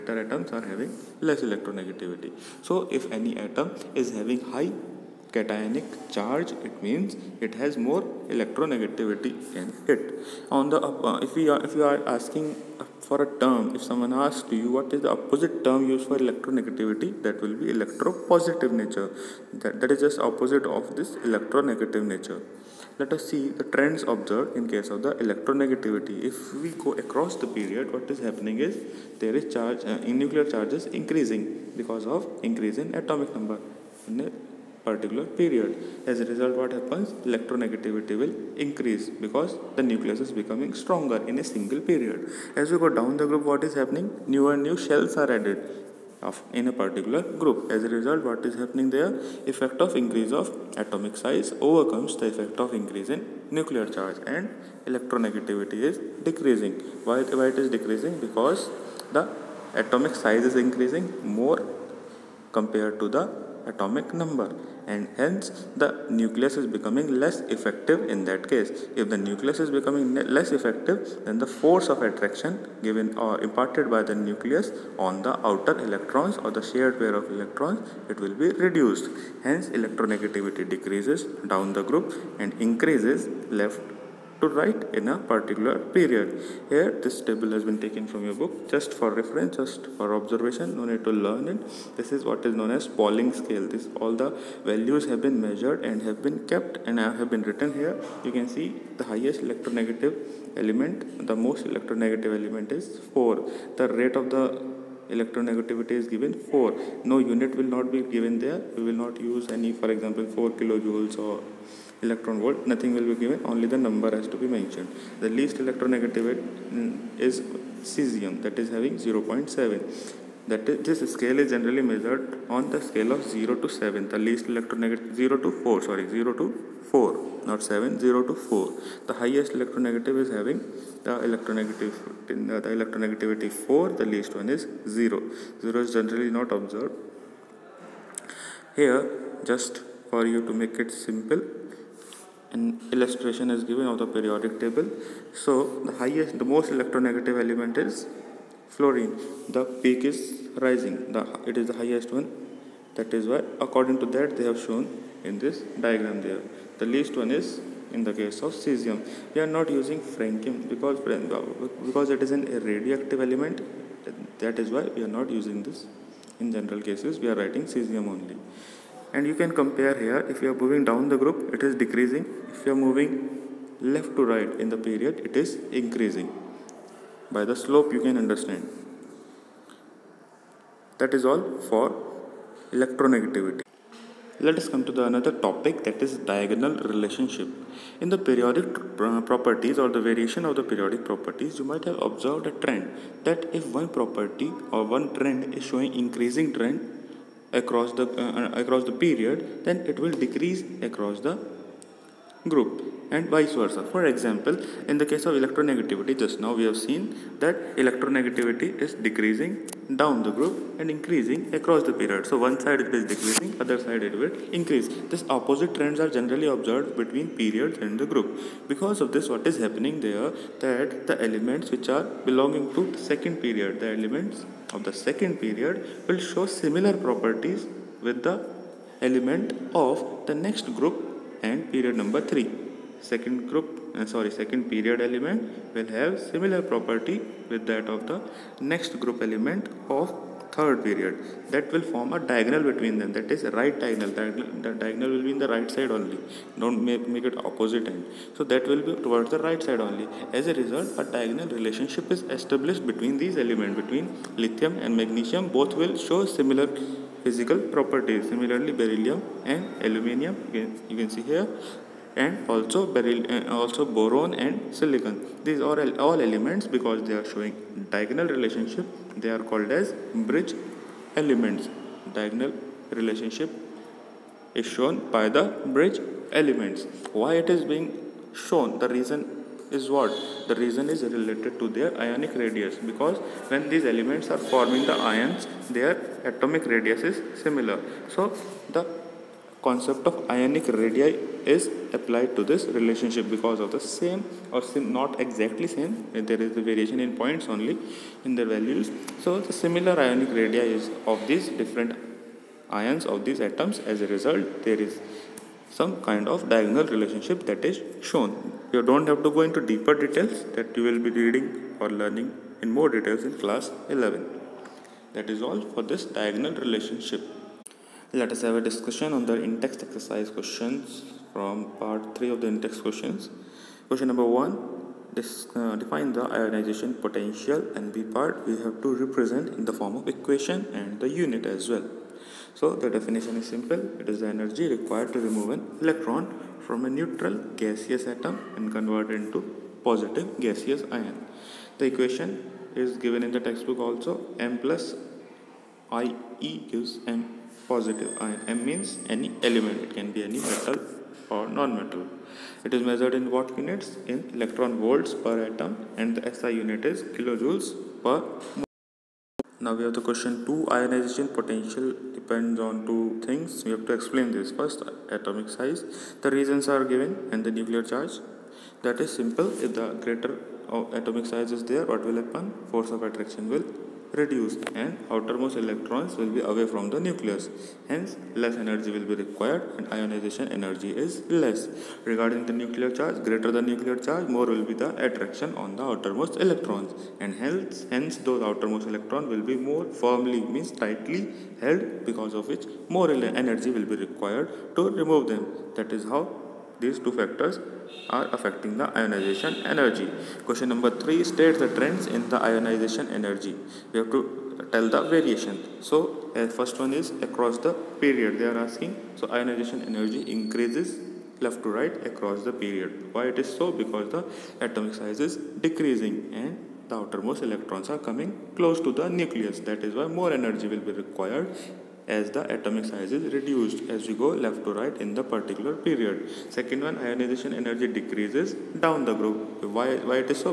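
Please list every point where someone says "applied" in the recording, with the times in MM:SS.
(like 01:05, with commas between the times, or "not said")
04:51.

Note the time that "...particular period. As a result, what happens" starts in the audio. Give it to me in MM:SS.
00:34.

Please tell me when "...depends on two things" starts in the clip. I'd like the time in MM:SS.
06:02.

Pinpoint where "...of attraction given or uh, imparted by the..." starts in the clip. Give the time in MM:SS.
01:11.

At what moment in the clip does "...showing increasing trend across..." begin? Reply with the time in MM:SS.
03:15.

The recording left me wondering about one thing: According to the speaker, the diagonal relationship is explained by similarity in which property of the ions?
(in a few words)
Ionic radius.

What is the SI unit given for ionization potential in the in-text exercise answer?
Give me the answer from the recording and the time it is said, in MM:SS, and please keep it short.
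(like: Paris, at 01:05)
Kilojoules per mole, at 05:57.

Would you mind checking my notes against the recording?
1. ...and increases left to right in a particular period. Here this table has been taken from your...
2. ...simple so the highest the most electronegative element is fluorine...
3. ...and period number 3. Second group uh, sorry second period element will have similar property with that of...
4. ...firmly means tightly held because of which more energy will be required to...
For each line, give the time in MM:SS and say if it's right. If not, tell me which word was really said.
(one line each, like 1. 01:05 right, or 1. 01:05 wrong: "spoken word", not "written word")
1. 01:22 right
2. 02:24 wrong: "table", not "simple"
3. 03:51 right
4. 06:29 right.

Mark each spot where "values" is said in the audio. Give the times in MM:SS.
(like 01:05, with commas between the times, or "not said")
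01:34, 04:58.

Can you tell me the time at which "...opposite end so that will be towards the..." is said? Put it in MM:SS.
04:07.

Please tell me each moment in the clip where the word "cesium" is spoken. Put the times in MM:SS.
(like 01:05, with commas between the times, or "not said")
01:57, 02:38, 02:47.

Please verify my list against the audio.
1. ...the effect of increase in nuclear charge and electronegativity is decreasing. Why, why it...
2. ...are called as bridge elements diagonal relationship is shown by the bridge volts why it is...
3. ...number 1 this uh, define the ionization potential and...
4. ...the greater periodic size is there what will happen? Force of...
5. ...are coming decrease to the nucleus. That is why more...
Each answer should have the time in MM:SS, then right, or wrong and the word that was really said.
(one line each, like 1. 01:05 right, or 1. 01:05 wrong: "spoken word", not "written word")
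1. 00:52 right
2. 04:29 wrong: "elements", not "volts"
3. 05:24 right
4. 06:09 wrong: "atomic", not "periodic"
5. 06:57 wrong: "close", not "decrease".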